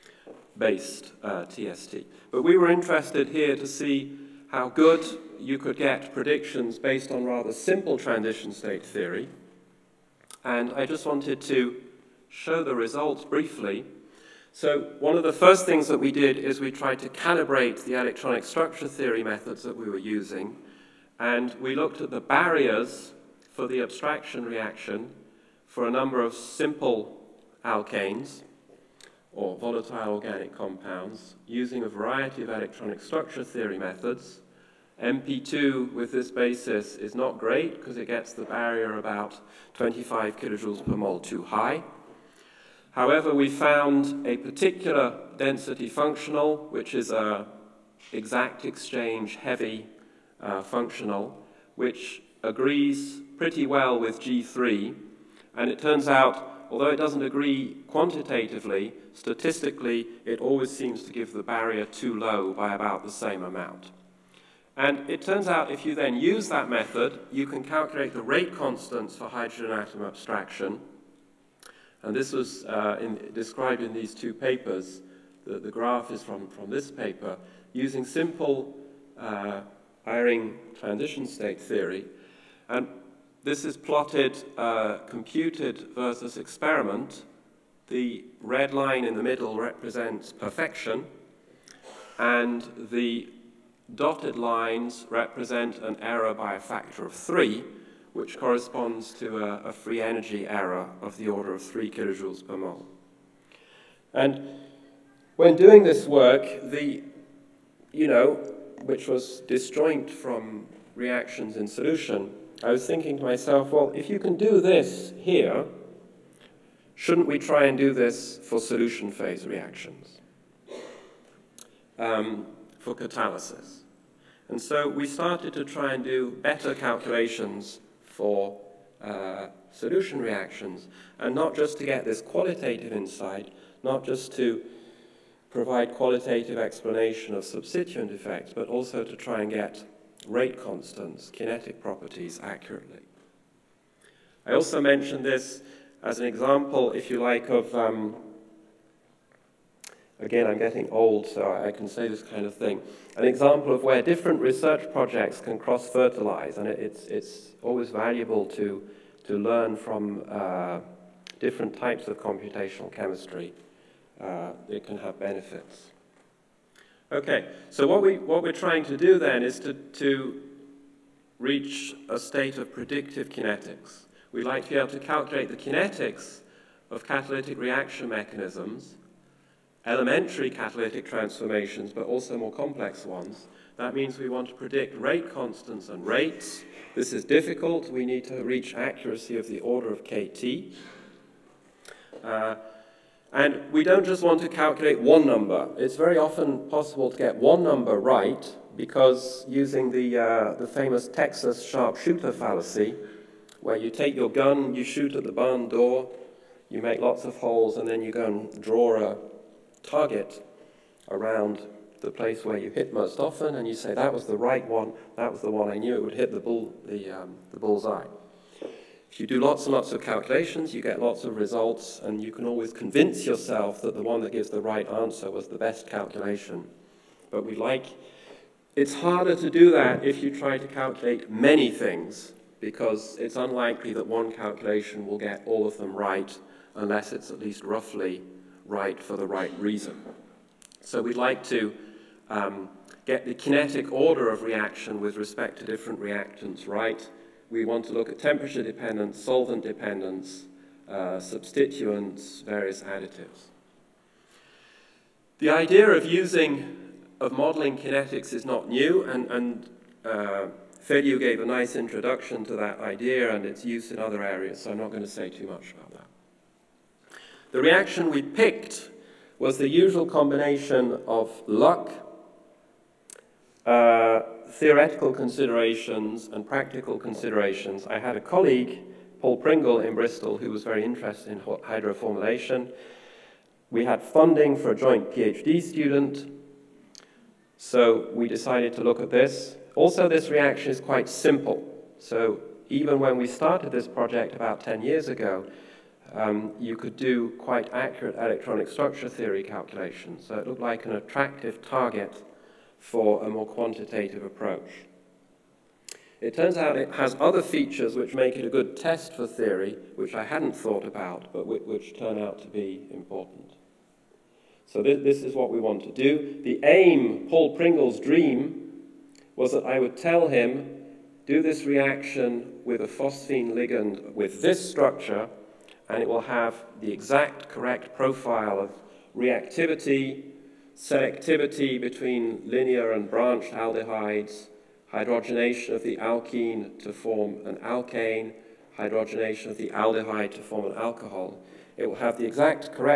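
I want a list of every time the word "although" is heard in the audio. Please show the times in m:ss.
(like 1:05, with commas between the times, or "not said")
0:56.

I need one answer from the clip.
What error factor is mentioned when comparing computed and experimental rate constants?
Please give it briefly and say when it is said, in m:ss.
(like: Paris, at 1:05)
3, at 1:36.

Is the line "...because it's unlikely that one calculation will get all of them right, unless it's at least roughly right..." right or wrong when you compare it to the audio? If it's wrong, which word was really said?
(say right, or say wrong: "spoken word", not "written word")
right.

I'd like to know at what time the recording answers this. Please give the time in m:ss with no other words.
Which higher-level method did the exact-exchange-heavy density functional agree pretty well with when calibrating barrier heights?
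0:54.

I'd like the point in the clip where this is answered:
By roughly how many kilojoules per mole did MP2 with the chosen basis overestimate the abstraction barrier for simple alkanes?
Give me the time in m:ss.
0:39.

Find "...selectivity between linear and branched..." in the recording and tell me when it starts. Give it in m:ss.
5:30.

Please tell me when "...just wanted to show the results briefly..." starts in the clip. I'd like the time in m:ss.
0:10.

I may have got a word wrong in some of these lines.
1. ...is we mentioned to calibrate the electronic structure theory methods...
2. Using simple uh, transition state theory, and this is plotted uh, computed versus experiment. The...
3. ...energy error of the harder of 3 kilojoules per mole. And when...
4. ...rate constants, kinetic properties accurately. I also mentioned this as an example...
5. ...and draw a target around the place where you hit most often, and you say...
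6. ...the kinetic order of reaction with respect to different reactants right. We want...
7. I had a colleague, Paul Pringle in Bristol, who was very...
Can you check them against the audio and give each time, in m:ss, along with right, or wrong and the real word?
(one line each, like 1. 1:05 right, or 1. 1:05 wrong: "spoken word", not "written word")
1. 0:16 wrong: "tried", not "mentioned"
2. 1:17 right
3. 1:40 wrong: "order", not "harder"
4. 2:20 right
5. 3:28 right
6. 4:03 right
7. 4:37 right.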